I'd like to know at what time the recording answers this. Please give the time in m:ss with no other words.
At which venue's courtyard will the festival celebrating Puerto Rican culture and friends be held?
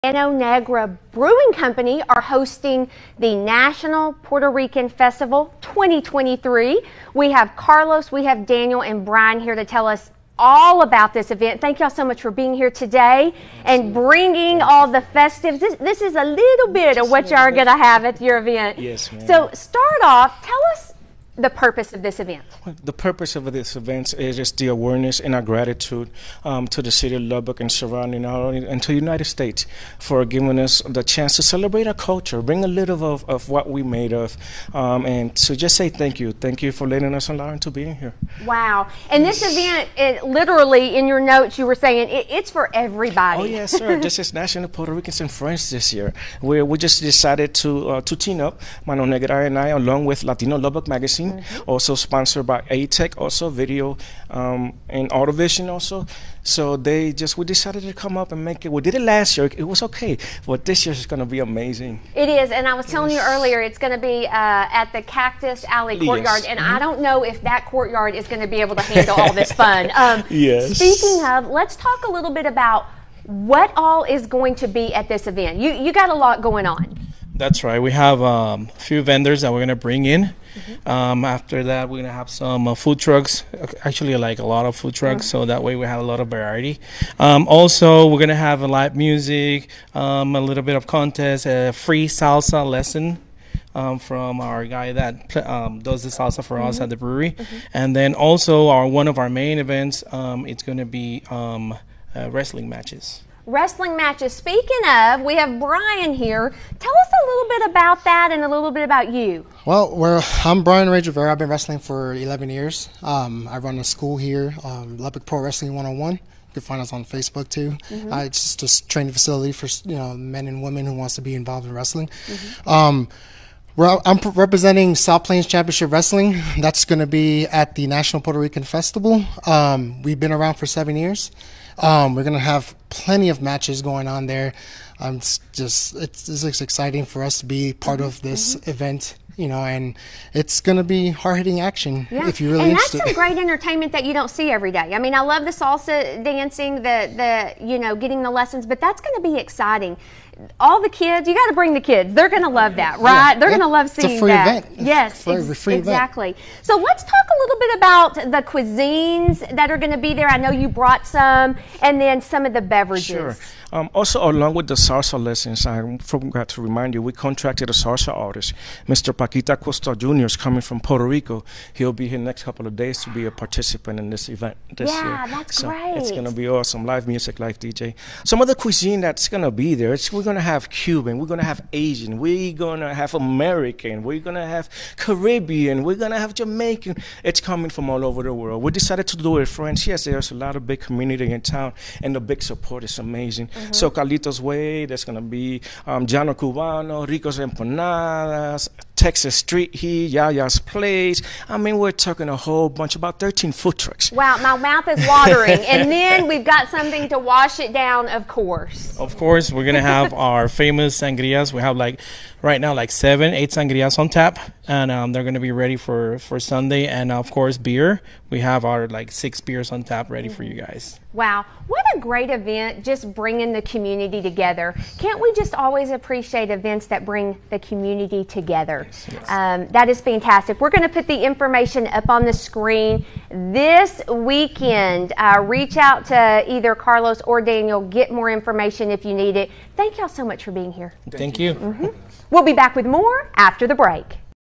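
1:05.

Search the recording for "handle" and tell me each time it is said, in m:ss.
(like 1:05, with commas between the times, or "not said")
1:08.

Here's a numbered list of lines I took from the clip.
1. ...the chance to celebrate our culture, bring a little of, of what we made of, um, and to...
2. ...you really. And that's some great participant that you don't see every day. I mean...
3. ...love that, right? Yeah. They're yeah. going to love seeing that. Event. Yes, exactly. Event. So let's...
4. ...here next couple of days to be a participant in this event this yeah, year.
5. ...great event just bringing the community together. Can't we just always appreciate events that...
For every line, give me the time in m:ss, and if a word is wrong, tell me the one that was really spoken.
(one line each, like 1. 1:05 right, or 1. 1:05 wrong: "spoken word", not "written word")
1. 0:30 right
2. 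2:22 wrong: "entertainment", not "participant"
3. 2:32 right
4. 2:52 right
5. 3:41 right.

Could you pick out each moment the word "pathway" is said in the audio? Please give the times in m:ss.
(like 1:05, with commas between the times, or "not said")
not said.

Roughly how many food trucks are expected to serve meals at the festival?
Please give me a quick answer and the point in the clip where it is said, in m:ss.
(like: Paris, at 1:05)
13, at 3:22.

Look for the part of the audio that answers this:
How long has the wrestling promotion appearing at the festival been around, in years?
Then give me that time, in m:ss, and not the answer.
2:10.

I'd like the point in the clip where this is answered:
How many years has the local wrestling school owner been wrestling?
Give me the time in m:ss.
1:52.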